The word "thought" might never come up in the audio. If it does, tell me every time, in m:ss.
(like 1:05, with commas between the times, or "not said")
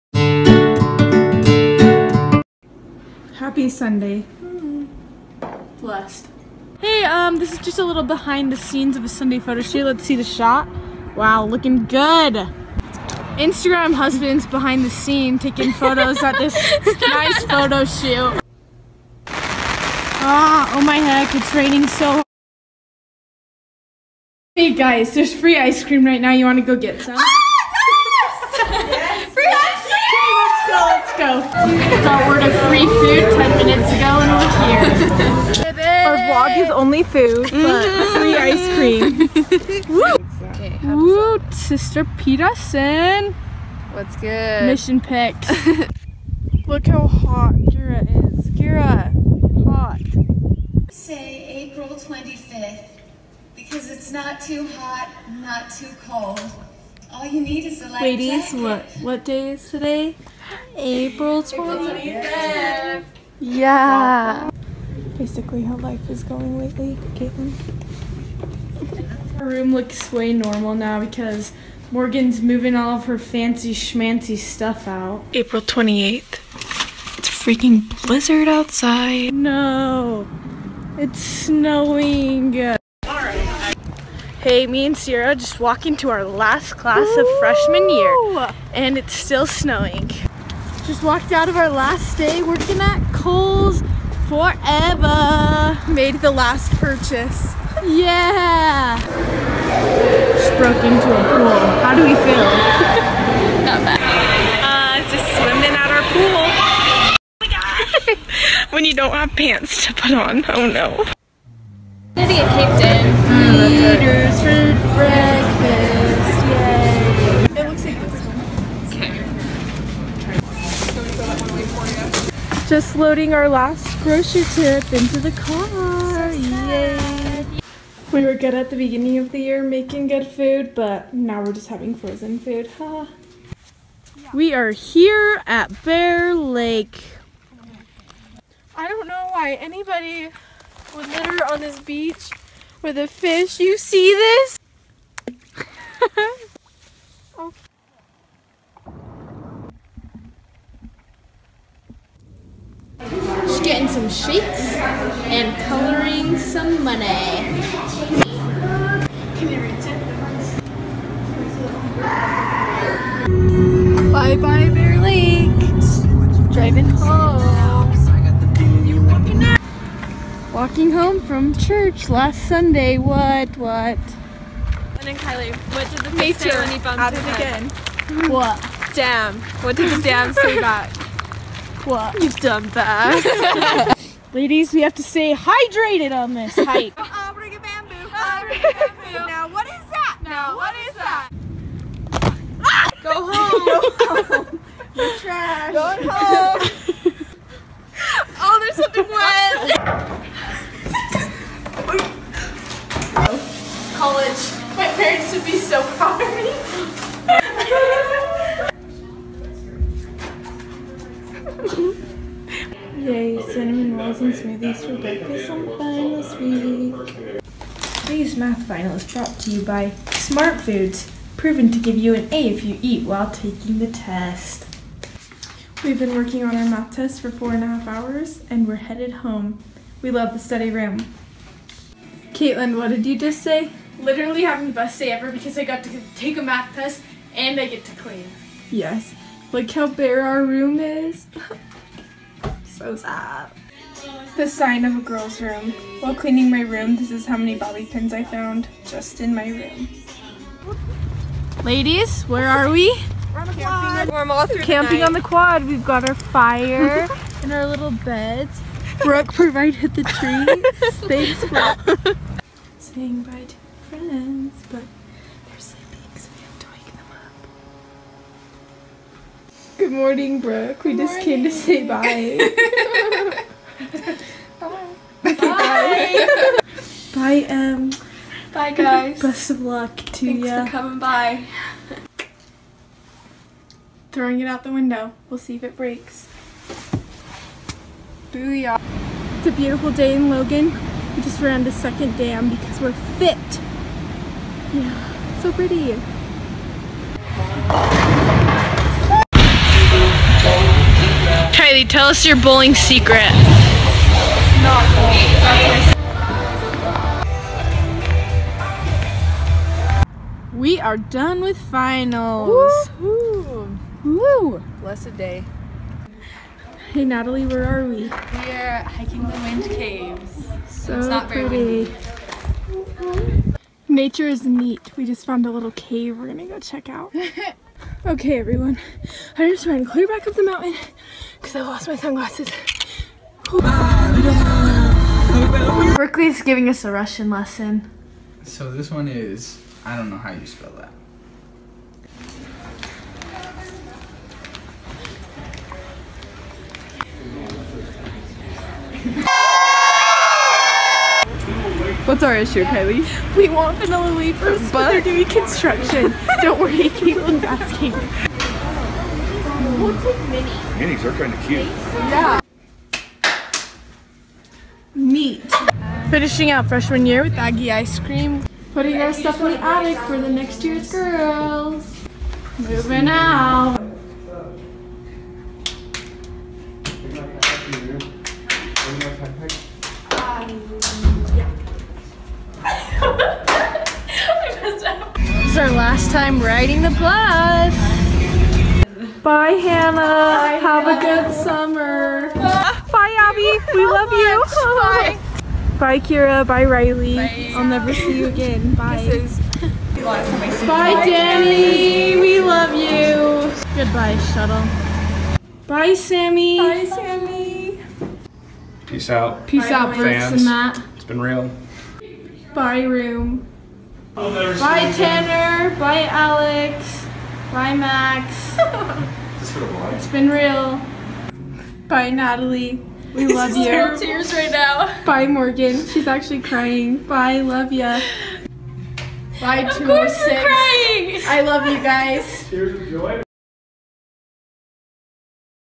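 not said.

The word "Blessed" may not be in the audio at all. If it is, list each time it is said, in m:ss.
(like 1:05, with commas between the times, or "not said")
0:05, 5:14.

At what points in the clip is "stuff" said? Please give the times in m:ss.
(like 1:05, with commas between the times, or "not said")
1:14, 6:09.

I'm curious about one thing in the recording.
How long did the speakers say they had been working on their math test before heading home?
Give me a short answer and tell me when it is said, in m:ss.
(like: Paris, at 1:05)
4.5 hours, at 3:47.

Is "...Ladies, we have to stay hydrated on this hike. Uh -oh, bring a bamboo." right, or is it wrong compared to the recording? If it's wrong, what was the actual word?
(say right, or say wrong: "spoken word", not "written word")
right.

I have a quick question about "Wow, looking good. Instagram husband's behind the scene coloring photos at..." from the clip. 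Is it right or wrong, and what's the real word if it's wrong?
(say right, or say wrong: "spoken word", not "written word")
wrong: "taking", not "coloring".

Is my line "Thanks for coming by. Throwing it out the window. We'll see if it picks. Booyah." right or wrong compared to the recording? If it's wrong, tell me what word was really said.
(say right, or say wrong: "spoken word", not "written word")
wrong: "breaks", not "picks".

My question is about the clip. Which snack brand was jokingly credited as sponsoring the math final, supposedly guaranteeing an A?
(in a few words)
Smart Foods.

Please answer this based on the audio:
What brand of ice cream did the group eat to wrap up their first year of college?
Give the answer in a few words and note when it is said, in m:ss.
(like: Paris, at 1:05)
Aggie ice cream, at 6:07.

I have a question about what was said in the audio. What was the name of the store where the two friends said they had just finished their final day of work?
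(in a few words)
Kohl's.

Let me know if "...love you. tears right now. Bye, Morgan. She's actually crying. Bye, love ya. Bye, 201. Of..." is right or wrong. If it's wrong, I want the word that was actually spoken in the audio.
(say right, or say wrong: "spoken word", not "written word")
wrong: "206", not "201".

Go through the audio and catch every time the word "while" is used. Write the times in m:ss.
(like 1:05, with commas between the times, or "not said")
3:43, 4:06.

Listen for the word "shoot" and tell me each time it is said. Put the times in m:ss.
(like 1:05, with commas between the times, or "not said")
0:09, 0:17.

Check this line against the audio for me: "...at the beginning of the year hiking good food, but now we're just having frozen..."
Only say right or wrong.
wrong.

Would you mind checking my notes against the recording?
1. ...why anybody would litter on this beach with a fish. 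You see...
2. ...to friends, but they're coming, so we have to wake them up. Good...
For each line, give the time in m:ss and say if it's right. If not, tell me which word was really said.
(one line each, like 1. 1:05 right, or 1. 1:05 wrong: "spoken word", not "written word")
1. 2:19 right
2. 4:23 wrong: "sleeping", not "coming".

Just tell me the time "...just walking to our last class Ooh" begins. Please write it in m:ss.
1:25.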